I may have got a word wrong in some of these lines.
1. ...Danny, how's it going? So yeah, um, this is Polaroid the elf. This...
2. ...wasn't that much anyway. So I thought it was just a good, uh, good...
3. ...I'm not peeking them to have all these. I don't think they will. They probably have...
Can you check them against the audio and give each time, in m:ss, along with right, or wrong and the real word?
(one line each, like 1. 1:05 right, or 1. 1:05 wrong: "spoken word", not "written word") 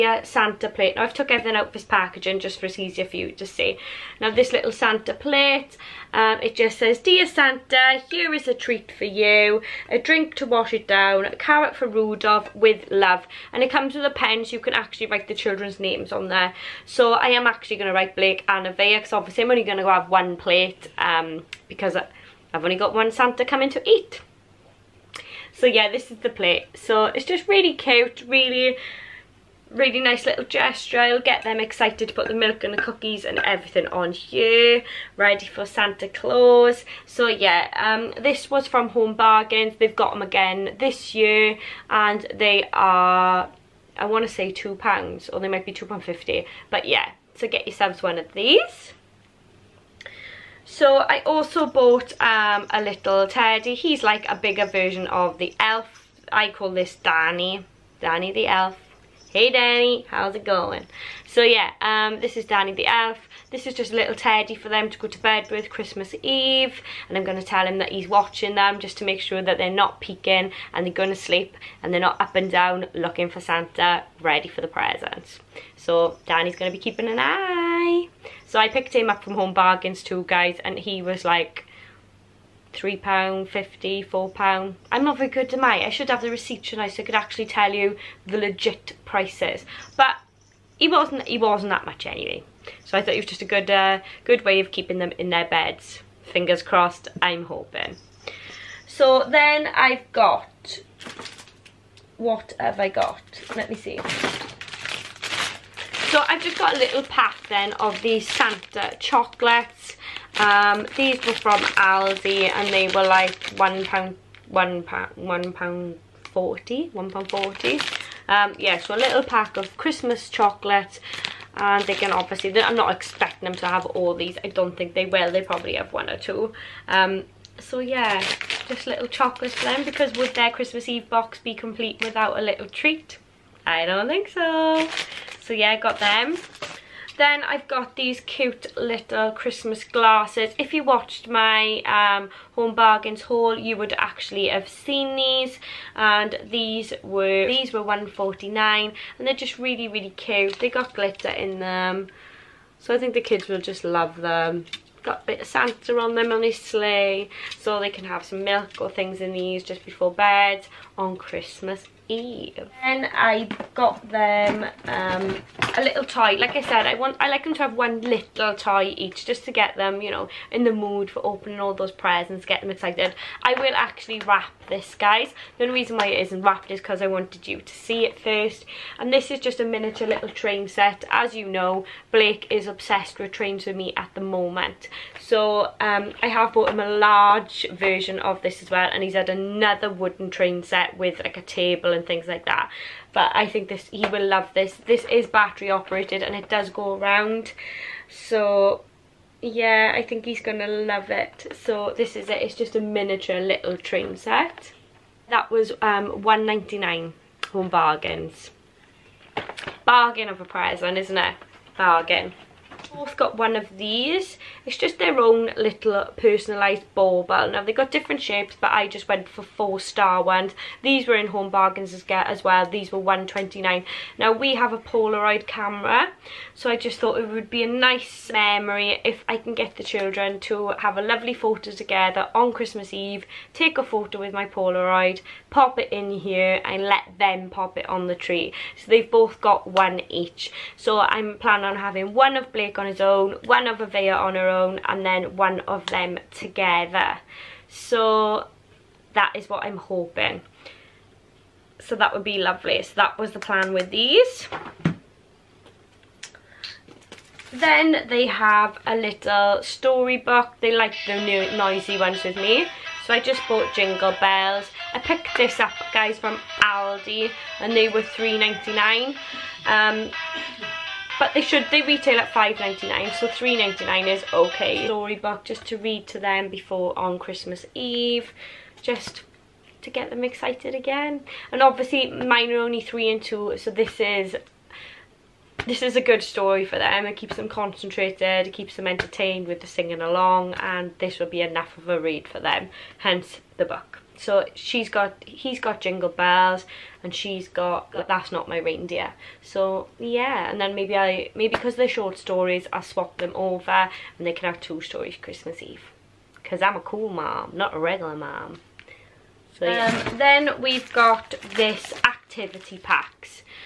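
1. 0:59 wrong: "Danny", not "Polaroid"
2. 1:31 right
3. 2:02 wrong: "expecting", not "peeking".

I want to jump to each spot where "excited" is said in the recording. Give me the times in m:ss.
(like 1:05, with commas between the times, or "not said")
0:31, 2:52, 4:40.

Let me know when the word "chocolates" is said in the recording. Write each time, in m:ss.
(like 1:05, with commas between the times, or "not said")
1:48, 2:00, 2:09.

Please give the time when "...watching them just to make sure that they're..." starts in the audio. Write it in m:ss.
1:08.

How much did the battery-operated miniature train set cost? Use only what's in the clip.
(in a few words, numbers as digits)
£1.99.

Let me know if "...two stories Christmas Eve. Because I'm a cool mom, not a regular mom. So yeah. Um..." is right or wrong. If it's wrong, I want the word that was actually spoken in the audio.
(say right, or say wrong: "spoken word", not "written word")
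right.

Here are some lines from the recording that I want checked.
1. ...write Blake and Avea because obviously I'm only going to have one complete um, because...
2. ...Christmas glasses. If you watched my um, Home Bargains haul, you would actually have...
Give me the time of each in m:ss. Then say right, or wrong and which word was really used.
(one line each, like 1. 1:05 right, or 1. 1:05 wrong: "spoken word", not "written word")
1. 0:17 wrong: "plate", not "complete"
2. 2:19 right.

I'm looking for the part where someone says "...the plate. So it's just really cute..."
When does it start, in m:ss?
0:26.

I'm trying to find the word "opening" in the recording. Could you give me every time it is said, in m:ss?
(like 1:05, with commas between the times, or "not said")
2:51.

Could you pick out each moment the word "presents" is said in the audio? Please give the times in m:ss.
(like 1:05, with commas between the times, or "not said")
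1:14, 2:51.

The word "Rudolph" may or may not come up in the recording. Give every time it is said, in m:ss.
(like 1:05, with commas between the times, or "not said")
0:11.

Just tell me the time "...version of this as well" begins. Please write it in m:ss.
3:07.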